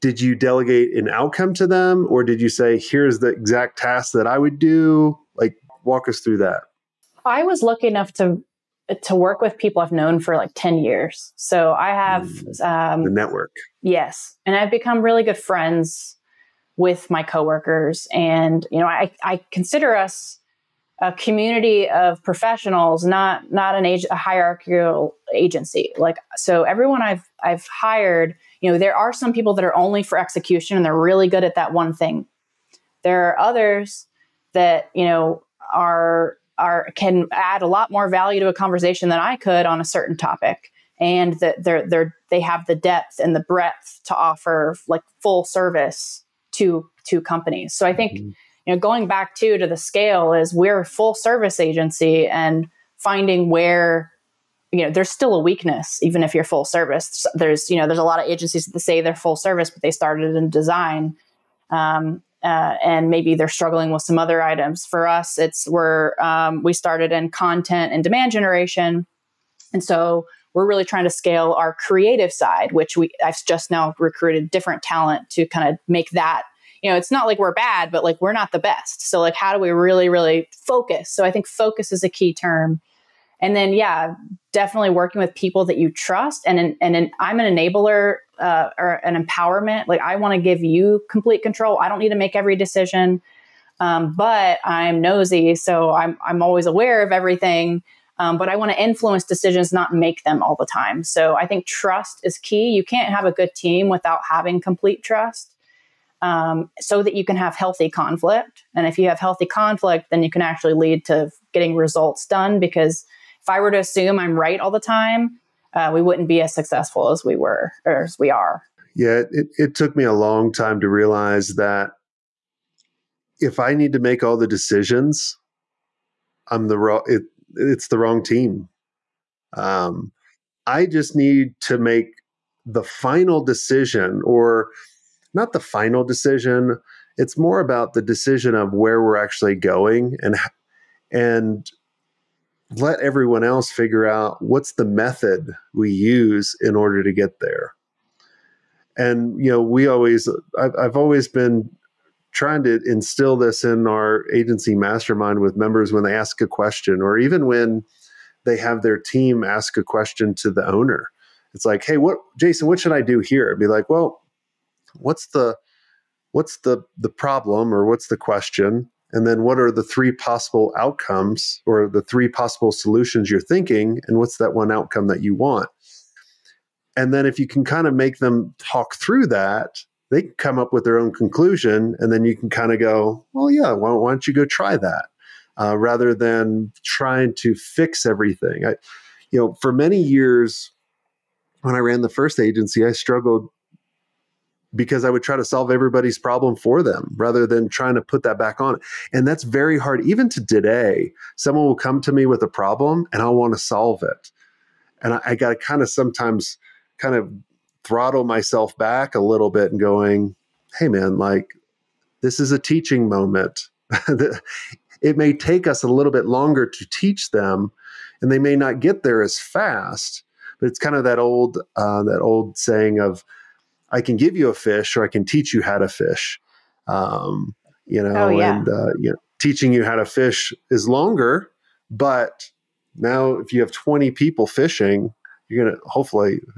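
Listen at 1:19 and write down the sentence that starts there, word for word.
So like how do we really, really focus?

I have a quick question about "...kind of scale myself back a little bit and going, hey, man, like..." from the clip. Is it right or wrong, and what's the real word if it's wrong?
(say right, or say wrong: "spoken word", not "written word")
wrong: "throttle", not "scale".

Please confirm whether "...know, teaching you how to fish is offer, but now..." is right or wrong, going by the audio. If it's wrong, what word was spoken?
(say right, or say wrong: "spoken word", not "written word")
wrong: "longer", not "offer".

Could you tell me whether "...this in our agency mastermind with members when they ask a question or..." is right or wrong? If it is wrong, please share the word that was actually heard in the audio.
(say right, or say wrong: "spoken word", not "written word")
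right.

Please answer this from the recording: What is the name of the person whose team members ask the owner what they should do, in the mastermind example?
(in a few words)
Jason.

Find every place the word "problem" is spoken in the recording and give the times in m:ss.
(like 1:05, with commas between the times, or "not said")
2:47, 3:16, 3:22.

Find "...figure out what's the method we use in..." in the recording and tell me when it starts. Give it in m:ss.
2:23.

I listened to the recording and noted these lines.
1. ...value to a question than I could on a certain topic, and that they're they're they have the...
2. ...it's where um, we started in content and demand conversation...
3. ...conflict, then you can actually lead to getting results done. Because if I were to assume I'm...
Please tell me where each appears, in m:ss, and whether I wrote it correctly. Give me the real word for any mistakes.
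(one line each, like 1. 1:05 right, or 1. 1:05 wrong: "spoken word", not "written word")
1. 0:38 wrong: "conversation", not "question"
2. 1:05 wrong: "generation", not "conversation"
3. 1:49 right.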